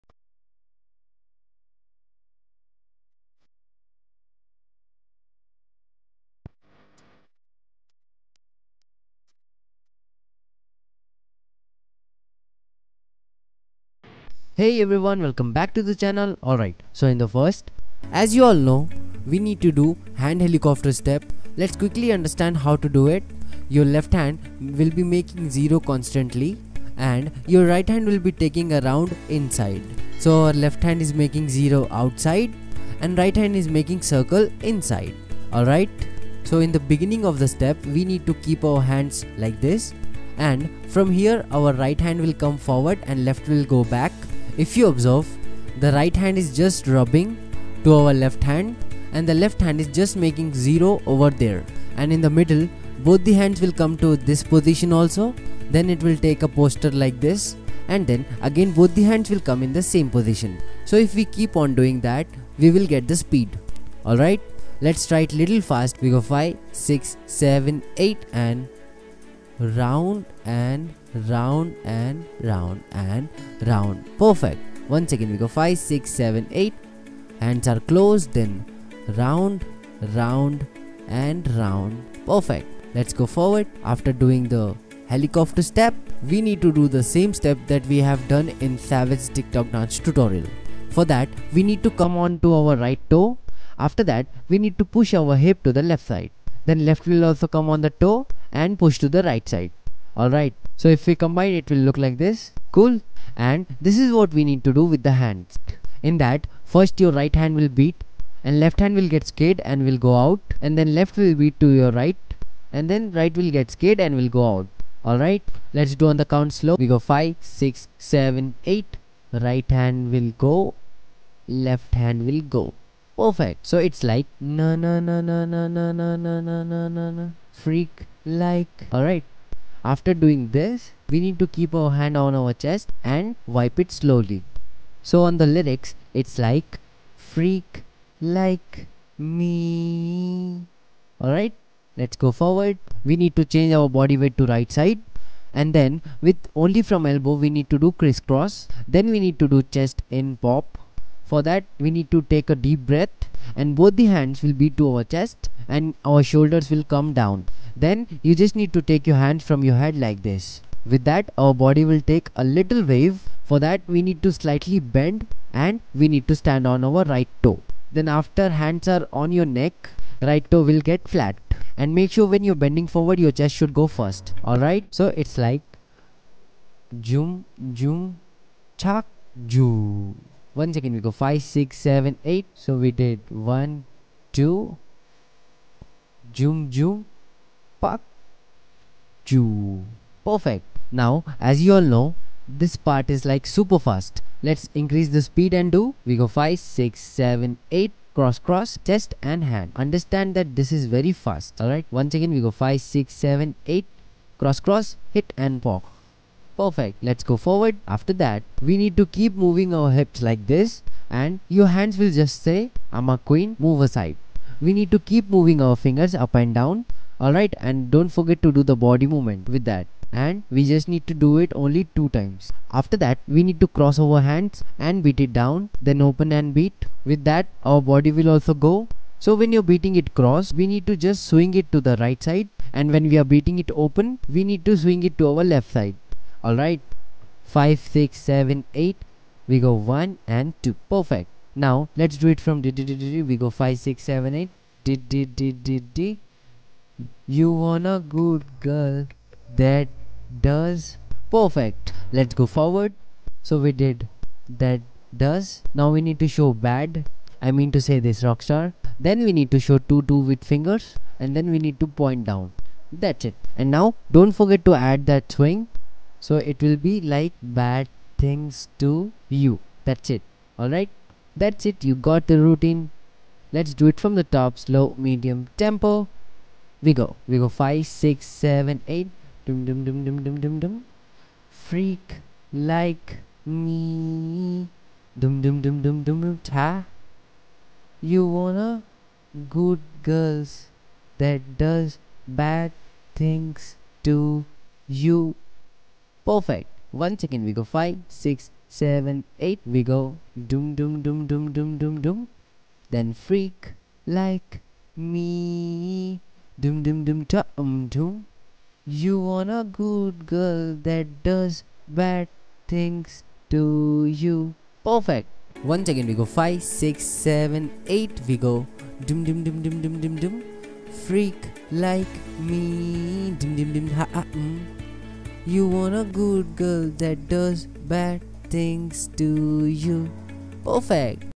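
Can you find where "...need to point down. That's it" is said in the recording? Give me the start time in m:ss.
4:21.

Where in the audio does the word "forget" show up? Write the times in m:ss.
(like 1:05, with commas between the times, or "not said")
3:38, 4:24.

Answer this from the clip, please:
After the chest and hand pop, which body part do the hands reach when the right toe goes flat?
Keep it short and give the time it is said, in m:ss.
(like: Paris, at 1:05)
Neck, at 2:49.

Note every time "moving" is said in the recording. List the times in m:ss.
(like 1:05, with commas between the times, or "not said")
3:29, 3:35.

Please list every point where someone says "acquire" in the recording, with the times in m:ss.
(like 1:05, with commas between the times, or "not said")
not said.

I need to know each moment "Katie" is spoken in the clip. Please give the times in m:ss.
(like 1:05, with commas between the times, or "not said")
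not said.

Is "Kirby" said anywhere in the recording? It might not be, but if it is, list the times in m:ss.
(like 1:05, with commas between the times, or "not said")
not said.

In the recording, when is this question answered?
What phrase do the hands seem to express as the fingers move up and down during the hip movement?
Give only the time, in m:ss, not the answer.
3:32.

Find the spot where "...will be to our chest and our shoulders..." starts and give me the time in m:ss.
2:34.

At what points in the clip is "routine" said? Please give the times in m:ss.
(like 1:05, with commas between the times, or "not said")
4:32.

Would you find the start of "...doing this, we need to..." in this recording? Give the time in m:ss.
2:10.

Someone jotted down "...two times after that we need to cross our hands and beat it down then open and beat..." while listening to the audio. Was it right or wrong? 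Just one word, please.
right.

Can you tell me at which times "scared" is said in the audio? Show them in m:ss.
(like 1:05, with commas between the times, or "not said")
1:49, 1:53.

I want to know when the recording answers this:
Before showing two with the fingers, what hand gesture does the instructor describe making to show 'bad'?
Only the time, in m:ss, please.
4:18.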